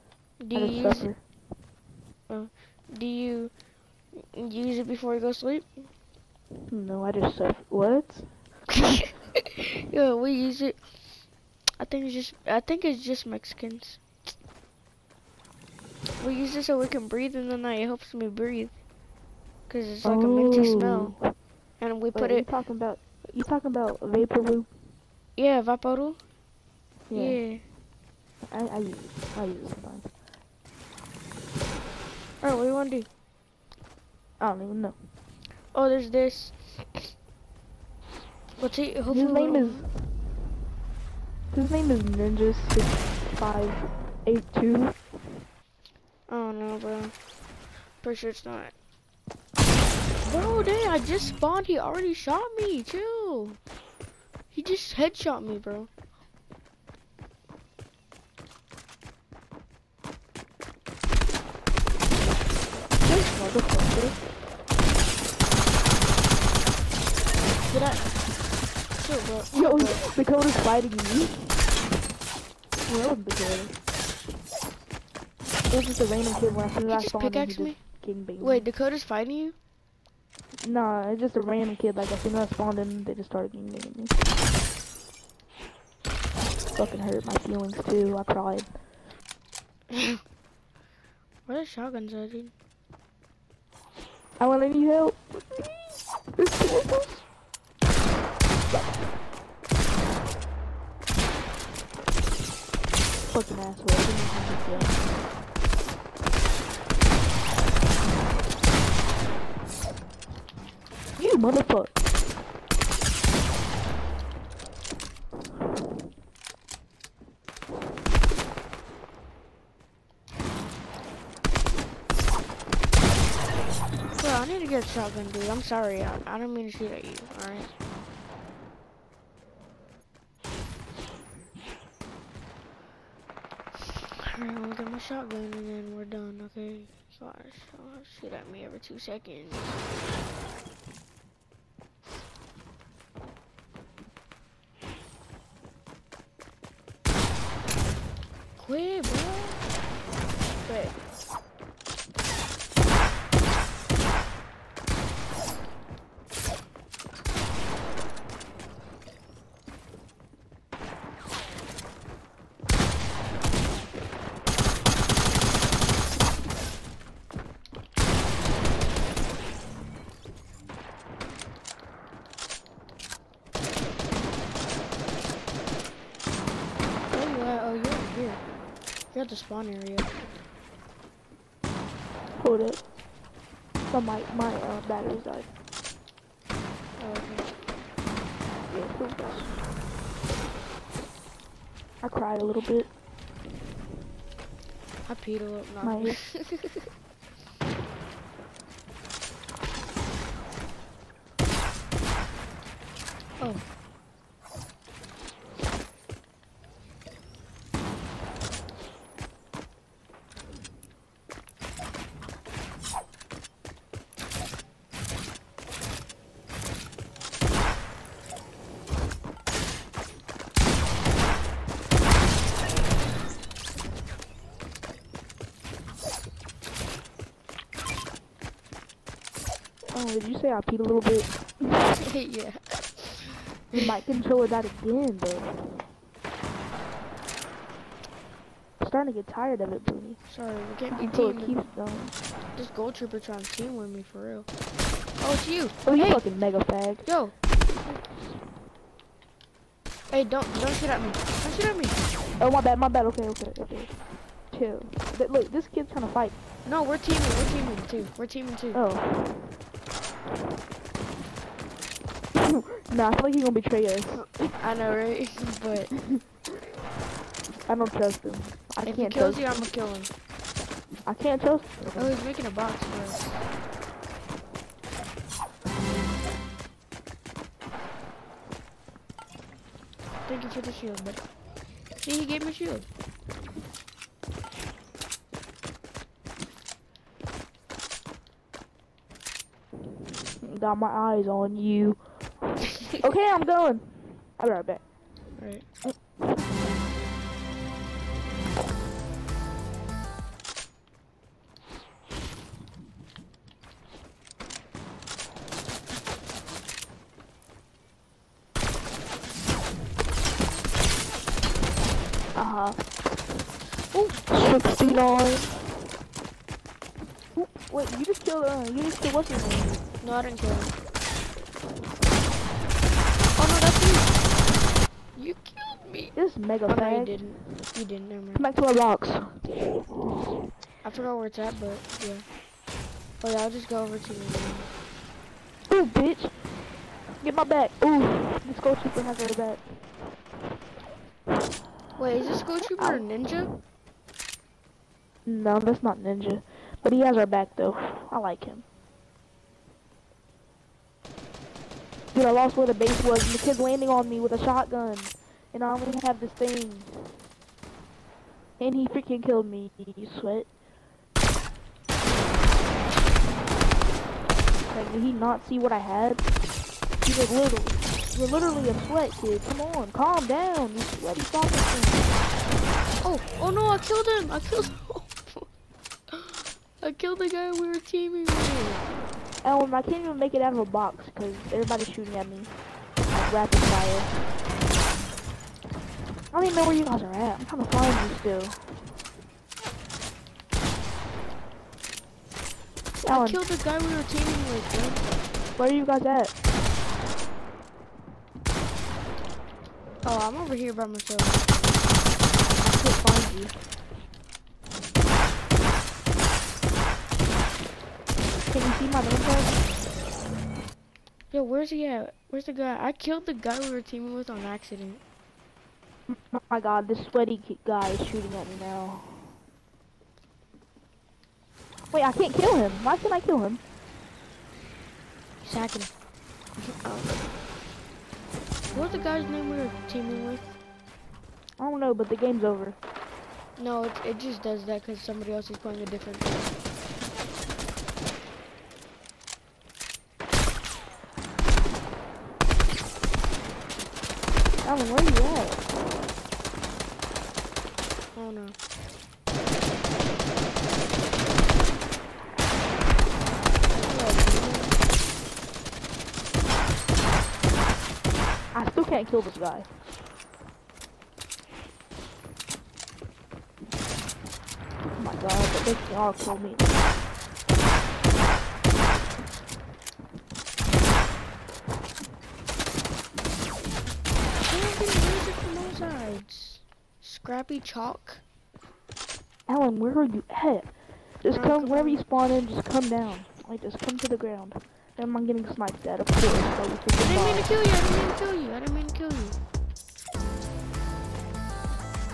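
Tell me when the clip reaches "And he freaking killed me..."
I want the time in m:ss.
5:58.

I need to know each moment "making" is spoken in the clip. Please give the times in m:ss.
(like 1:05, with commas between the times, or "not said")
4:32.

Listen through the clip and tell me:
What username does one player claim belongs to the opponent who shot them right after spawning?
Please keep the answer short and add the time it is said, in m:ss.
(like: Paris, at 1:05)
Ninja Six Five Eight Two, at 0:42.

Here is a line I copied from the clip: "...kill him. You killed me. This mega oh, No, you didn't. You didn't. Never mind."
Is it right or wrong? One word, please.
right.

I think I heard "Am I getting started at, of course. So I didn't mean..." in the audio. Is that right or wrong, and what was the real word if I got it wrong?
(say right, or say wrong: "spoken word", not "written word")
wrong: "sniped", not "started".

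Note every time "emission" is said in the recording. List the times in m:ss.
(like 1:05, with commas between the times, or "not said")
not said.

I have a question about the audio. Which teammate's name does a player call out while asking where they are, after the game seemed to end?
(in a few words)
Calvin.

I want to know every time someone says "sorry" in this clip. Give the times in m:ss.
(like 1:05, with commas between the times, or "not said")
2:05, 4:00.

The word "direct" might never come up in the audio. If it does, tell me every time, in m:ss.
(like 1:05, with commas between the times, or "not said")
not said.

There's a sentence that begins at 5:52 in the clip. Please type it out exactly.
Dude, I lost where the base was, and the kid's landing on me with a shotgun.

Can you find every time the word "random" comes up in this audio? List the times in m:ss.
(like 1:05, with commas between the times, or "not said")
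1:16, 1:21.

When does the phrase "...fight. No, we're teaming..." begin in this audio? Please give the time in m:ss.
4:16.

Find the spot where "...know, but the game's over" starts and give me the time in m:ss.
7:11.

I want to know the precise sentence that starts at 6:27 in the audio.
I'm trying to find you still.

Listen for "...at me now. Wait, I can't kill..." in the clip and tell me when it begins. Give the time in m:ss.
6:58.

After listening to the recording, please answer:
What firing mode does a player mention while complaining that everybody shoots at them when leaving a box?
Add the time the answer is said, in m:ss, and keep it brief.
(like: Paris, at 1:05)
Rapid fire, at 6:23.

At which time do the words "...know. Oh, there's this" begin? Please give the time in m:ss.
0:34.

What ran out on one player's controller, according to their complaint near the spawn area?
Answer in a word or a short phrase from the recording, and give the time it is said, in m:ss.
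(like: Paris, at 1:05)
Batteries, at 3:04.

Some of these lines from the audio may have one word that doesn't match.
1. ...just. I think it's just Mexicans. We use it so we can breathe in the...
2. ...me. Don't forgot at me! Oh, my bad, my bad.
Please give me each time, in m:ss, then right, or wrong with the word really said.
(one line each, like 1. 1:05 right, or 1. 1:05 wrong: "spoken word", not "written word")
1. 0:12 right
2. 4:11 wrong: "shoot", not "forgot".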